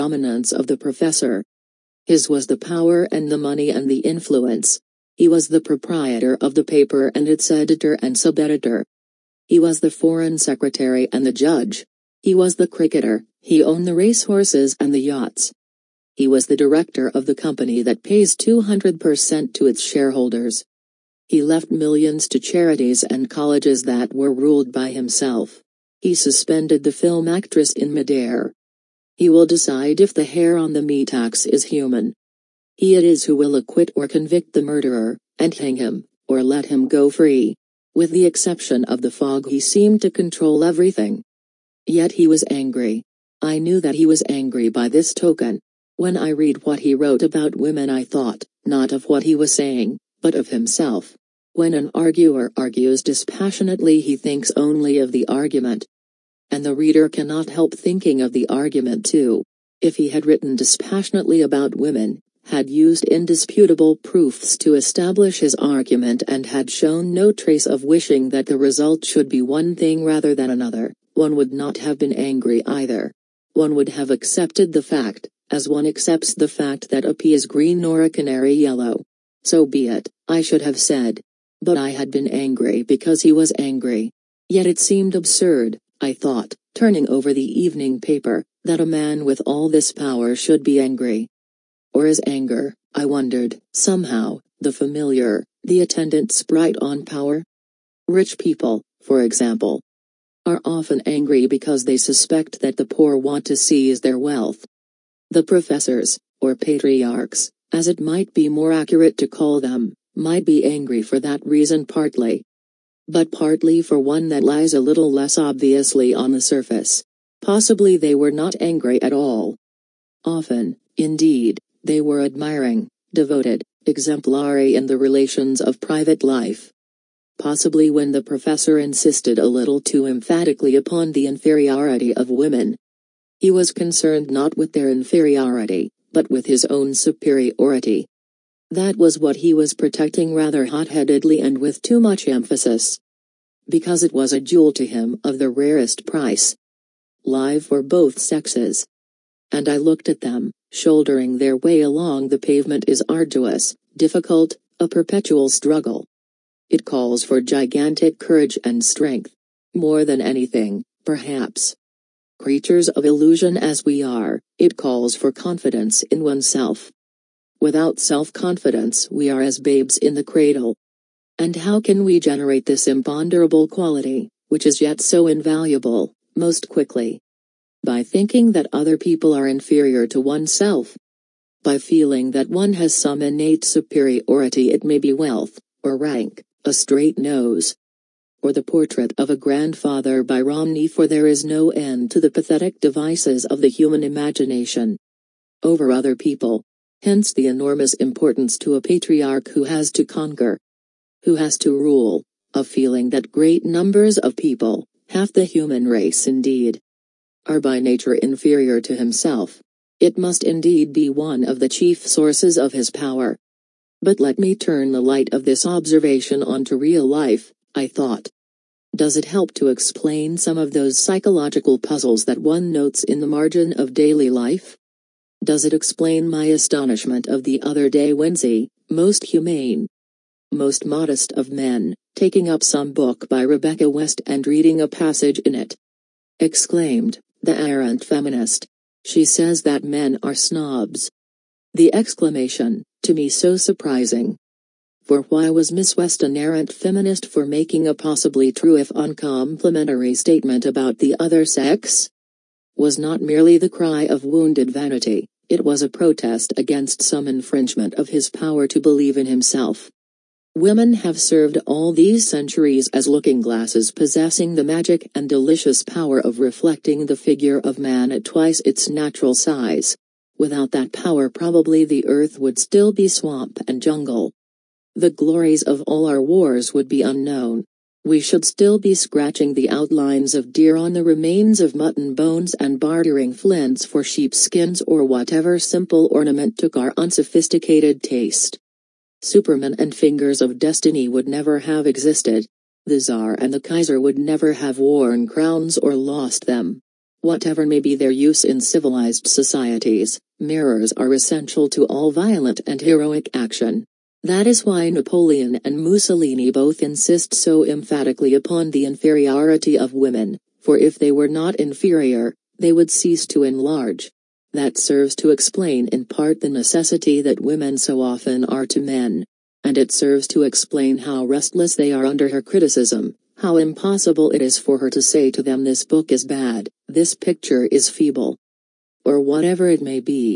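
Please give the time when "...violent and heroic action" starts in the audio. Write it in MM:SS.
05:02.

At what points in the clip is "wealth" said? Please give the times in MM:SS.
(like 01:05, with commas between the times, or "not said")
01:44, 03:05.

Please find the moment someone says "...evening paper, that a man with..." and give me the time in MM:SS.
01:27.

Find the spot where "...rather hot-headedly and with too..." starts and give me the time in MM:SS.
02:20.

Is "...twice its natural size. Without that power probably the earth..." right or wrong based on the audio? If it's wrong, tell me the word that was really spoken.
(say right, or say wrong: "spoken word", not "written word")
right.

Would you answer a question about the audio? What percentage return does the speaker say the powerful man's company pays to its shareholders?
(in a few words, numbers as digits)
200%.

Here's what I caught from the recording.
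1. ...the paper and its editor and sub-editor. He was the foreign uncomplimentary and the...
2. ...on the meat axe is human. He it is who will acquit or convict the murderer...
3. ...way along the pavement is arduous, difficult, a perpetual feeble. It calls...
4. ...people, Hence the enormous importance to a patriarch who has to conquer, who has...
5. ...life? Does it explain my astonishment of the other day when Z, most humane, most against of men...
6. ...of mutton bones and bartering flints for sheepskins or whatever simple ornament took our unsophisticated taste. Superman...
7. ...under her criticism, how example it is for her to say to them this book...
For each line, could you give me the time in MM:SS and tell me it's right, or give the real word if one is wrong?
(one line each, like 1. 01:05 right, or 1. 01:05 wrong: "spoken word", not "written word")
1. 00:06 wrong: "secretary", not "uncomplimentary"
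2. 00:30 right
3. 02:31 wrong: "struggle", not "feeble"
4. 03:16 right
5. 03:44 wrong: "modest", not "against"
6. 04:41 right
7. 05:22 wrong: "impossible", not "example".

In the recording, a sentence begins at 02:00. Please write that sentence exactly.
Often, indeed, they were admiring, devoted, exemplary in the relations of private life.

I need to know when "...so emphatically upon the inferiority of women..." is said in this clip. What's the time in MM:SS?
05:07.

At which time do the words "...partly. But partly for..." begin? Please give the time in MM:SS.
01:51.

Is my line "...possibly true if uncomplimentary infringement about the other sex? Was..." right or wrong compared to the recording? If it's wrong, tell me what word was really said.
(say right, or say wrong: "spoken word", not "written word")
wrong: "statement", not "infringement".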